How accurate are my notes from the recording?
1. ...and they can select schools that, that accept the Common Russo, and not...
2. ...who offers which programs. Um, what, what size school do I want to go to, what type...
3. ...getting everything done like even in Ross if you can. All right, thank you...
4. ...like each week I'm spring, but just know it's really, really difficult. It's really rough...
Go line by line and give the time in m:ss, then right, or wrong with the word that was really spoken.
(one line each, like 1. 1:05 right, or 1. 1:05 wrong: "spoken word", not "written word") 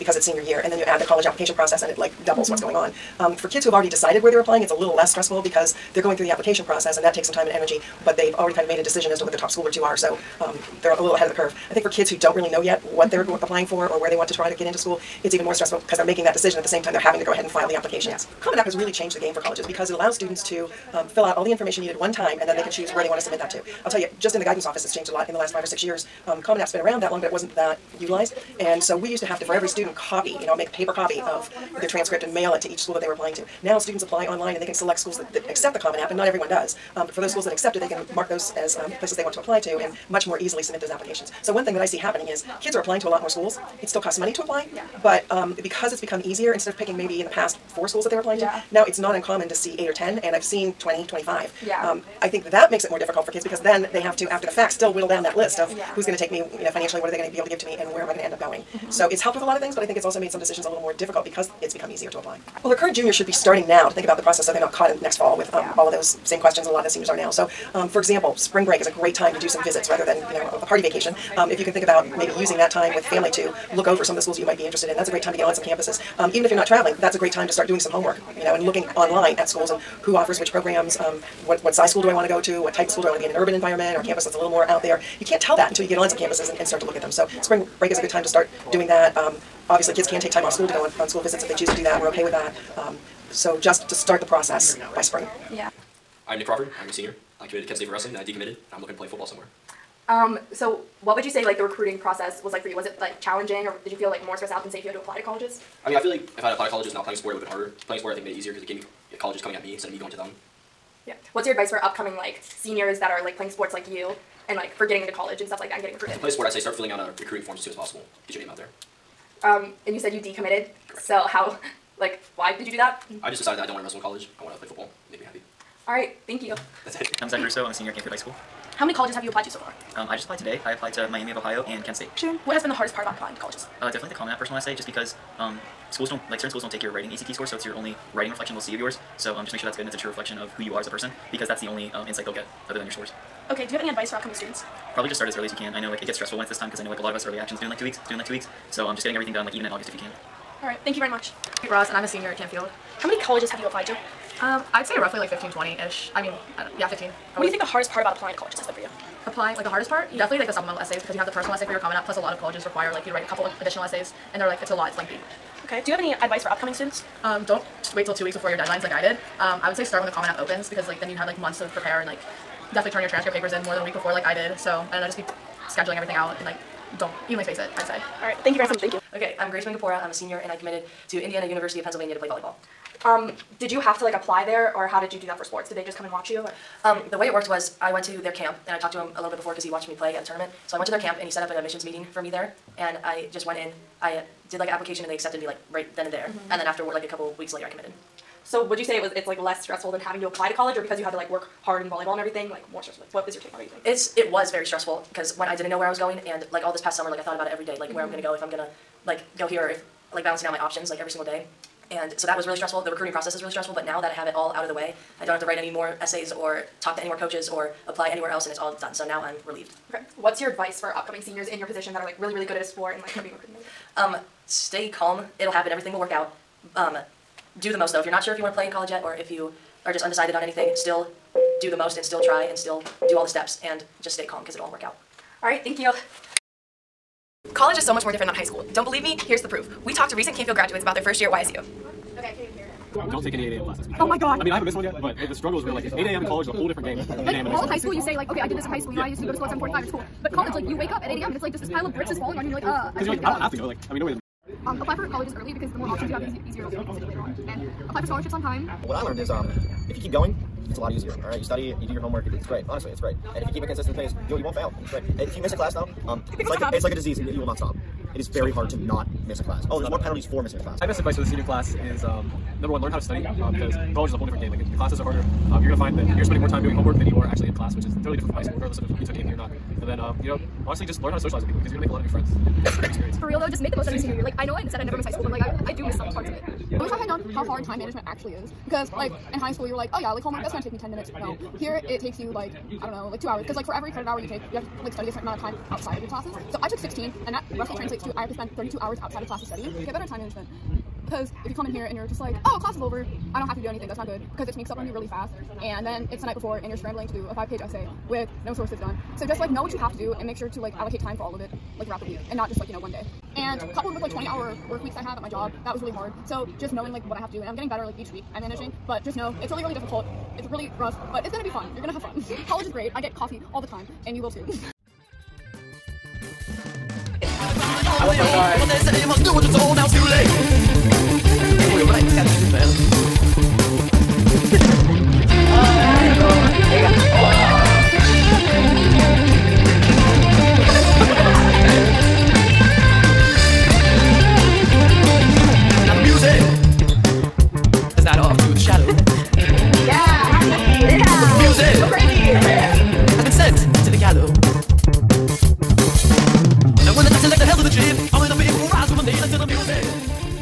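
1. 0:34 wrong: "App", not "Russo"
2. 1:20 right
3. 2:29 wrong: "August", not "Ross"
4. 5:17 wrong: "managing", not "spring".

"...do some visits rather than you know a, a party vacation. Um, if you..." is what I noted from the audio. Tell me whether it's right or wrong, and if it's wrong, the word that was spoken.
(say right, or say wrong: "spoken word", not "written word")
right.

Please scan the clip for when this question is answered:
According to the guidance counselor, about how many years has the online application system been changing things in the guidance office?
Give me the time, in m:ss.
0:25.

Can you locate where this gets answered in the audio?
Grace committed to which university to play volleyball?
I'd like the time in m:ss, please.
3:01.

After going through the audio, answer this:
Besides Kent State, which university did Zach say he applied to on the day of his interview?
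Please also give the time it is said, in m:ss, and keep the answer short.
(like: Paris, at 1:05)
Miami of Ohio, at 2:11.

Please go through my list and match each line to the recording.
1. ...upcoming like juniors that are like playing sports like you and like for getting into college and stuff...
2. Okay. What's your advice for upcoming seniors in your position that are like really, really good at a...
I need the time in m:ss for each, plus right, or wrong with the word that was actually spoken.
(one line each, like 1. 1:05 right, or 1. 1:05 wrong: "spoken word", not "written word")
1. 1:51 wrong: "seniors", not "juniors"
2. 3:39 right.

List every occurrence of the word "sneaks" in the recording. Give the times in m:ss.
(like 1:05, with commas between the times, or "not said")
5:04.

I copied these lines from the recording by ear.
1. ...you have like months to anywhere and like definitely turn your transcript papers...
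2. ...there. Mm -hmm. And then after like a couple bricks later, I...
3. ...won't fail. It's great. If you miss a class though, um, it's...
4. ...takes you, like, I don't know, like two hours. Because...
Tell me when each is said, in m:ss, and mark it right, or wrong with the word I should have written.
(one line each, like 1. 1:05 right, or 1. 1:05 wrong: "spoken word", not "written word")
1. 2:51 wrong: "prepare", not "anywhere"
2. 3:16 wrong: "weeks", not "bricks"
3. 4:24 right
4. 4:51 right.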